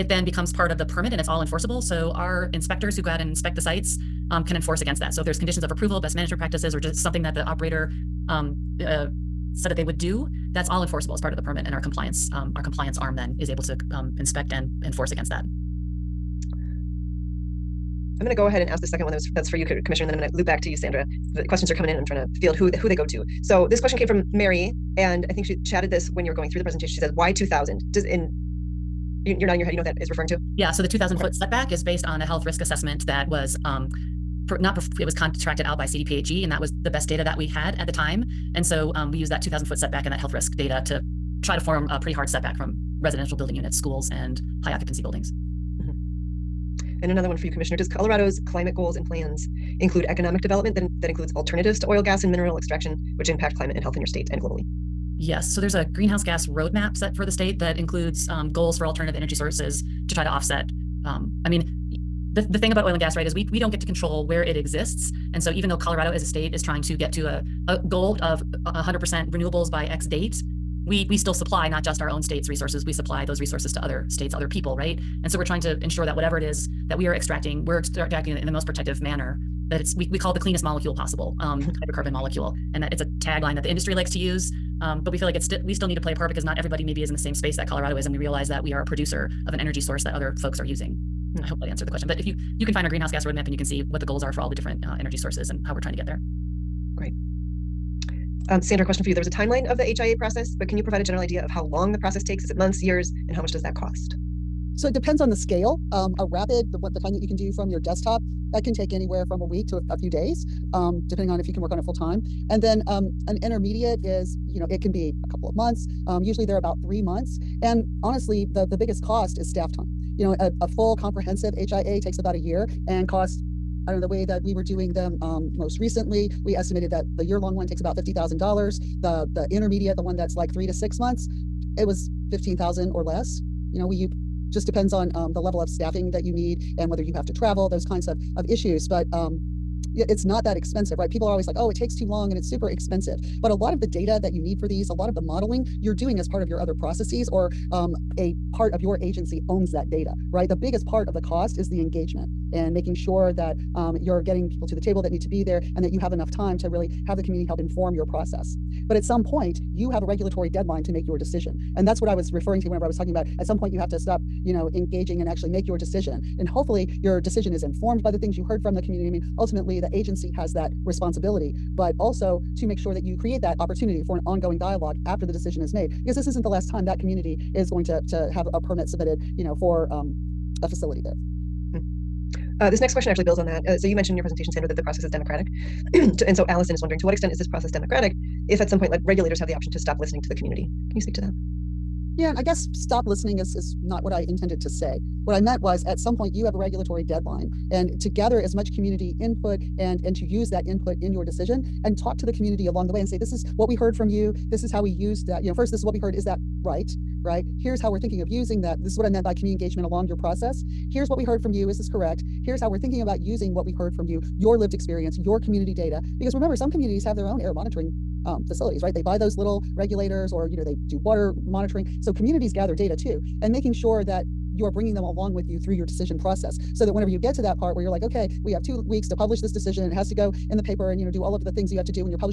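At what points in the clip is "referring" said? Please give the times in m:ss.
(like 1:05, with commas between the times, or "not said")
0:30, 2:42.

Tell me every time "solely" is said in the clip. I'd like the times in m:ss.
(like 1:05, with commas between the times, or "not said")
not said.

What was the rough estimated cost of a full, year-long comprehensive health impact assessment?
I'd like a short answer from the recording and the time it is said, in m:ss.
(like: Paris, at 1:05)
$50,000, at 2:07.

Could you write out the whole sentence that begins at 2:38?
But at some point, you have a regulatory deadline to make your decision.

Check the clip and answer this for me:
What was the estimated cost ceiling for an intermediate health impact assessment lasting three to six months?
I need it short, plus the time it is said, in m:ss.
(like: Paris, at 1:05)
15,000, at 2:12.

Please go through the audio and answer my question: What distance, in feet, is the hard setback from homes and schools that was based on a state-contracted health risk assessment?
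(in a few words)
2,000 foot.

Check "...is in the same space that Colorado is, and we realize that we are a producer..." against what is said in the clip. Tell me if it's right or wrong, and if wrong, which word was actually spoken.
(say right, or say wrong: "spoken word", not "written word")
right.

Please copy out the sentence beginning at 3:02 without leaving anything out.
Uh, this next question actually builds on that.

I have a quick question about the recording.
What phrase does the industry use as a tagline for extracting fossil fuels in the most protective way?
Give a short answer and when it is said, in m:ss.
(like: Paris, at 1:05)
the cleanest molecule possible, at 1:20.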